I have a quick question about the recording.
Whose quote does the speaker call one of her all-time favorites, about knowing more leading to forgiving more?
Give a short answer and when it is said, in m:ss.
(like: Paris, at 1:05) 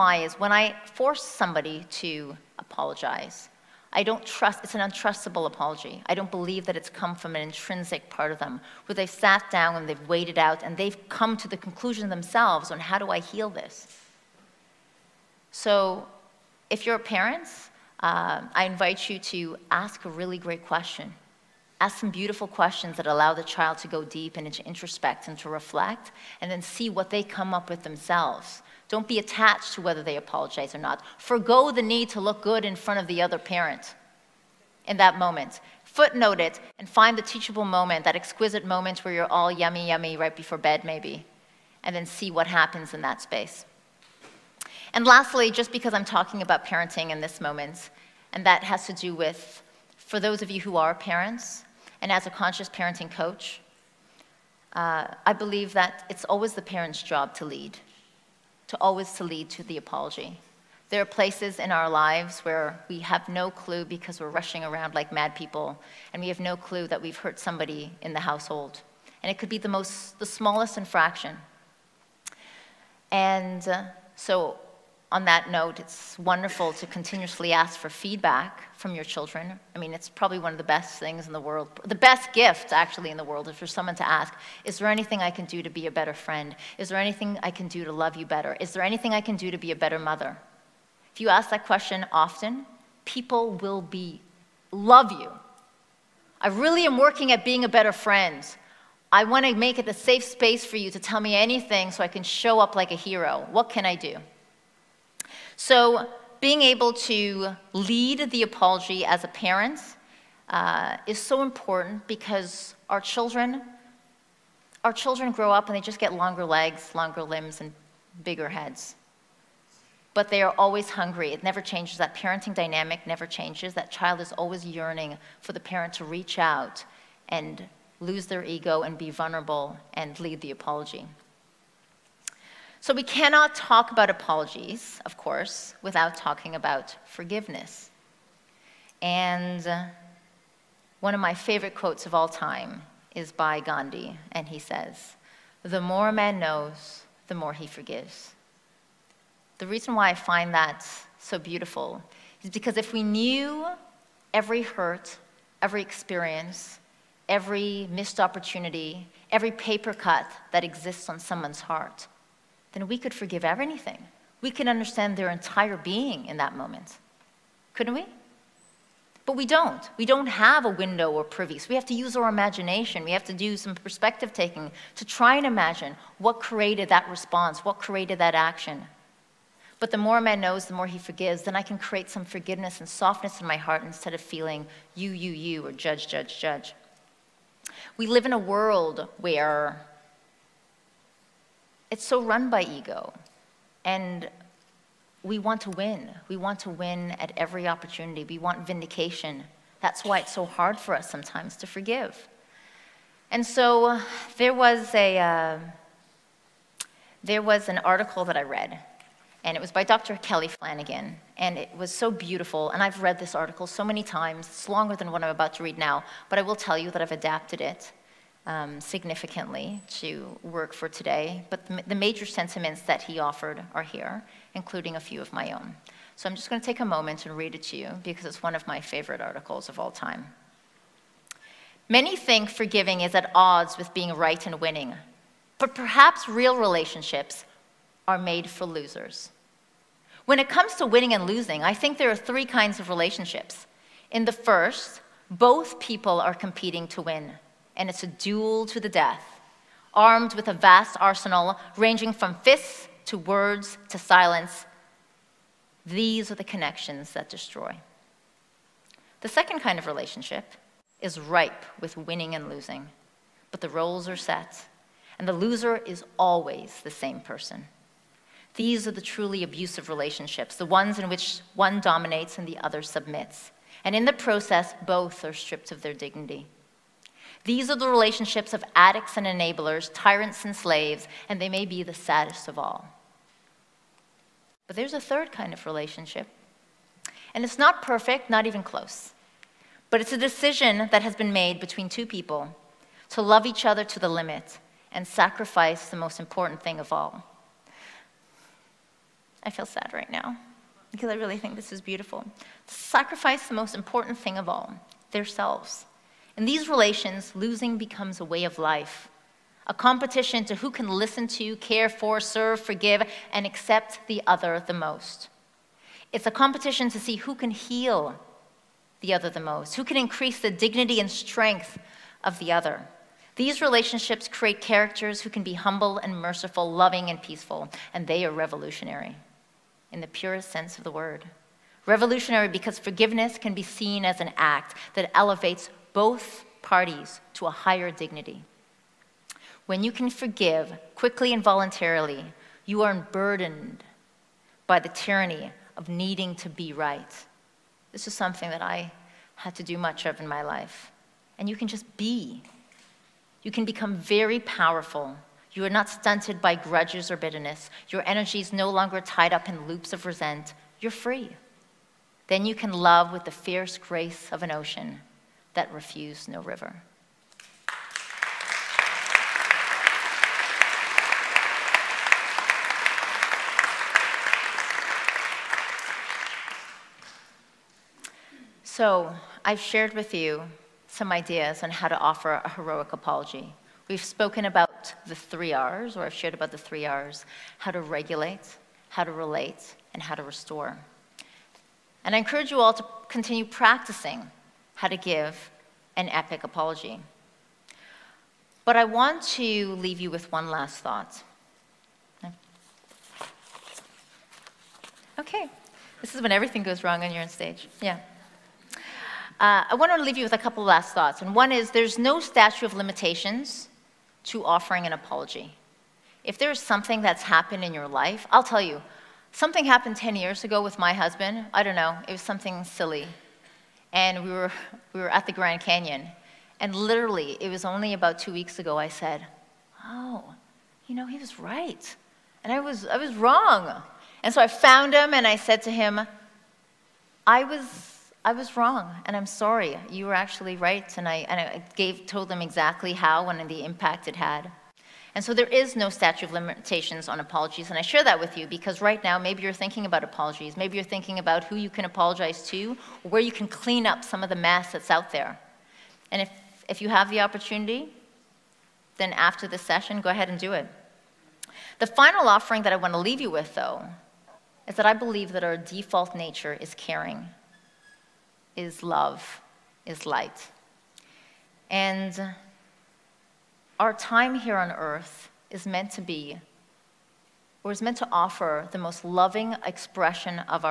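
Gandhi, at 2:23.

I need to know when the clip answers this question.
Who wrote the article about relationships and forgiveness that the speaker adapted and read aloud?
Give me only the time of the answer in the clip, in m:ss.
3:29.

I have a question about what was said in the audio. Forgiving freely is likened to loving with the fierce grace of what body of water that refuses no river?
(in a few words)
an ocean.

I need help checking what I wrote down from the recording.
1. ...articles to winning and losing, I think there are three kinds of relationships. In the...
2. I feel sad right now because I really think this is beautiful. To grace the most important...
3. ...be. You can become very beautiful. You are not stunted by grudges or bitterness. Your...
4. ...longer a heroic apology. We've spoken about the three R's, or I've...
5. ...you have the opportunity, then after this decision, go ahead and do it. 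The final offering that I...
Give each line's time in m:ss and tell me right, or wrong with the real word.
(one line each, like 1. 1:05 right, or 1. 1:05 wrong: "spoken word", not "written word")
1. 4:00 wrong: "comes", not "articles"
2. 4:59 wrong: "sacrifice", not "grace"
3. 5:51 wrong: "powerful", not "beautiful"
4. 6:21 wrong: "offer", not "longer"
5. 7:36 wrong: "session", not "decision".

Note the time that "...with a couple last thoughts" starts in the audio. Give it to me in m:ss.
6:50.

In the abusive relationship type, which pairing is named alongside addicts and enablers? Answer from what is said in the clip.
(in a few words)
tyrants and slaves.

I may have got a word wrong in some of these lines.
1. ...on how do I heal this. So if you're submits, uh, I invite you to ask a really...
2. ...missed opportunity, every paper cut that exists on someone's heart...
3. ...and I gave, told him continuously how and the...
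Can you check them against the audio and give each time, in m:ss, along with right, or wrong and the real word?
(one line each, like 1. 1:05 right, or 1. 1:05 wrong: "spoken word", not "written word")
1. 0:12 wrong: "parents", not "submits"
2. 2:37 right
3. 7:21 wrong: "exactly", not "continuously".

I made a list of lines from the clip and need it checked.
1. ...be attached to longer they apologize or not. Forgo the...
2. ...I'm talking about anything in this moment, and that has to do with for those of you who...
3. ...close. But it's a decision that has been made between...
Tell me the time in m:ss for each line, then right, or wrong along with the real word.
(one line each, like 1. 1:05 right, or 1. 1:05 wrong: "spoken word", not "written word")
1. 0:29 wrong: "whether", not "longer"
2. 0:45 wrong: "parenting", not "anything"
3. 4:48 right.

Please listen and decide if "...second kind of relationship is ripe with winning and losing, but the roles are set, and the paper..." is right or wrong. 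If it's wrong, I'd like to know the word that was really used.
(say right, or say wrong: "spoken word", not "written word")
wrong: "loser", not "paper".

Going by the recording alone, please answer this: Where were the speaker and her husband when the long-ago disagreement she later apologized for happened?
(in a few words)
the Grand Canyon.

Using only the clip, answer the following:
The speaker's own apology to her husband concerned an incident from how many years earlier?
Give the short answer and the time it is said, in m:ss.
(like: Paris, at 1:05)
10, at 6:59.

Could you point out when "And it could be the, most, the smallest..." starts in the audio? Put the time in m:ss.
1:09.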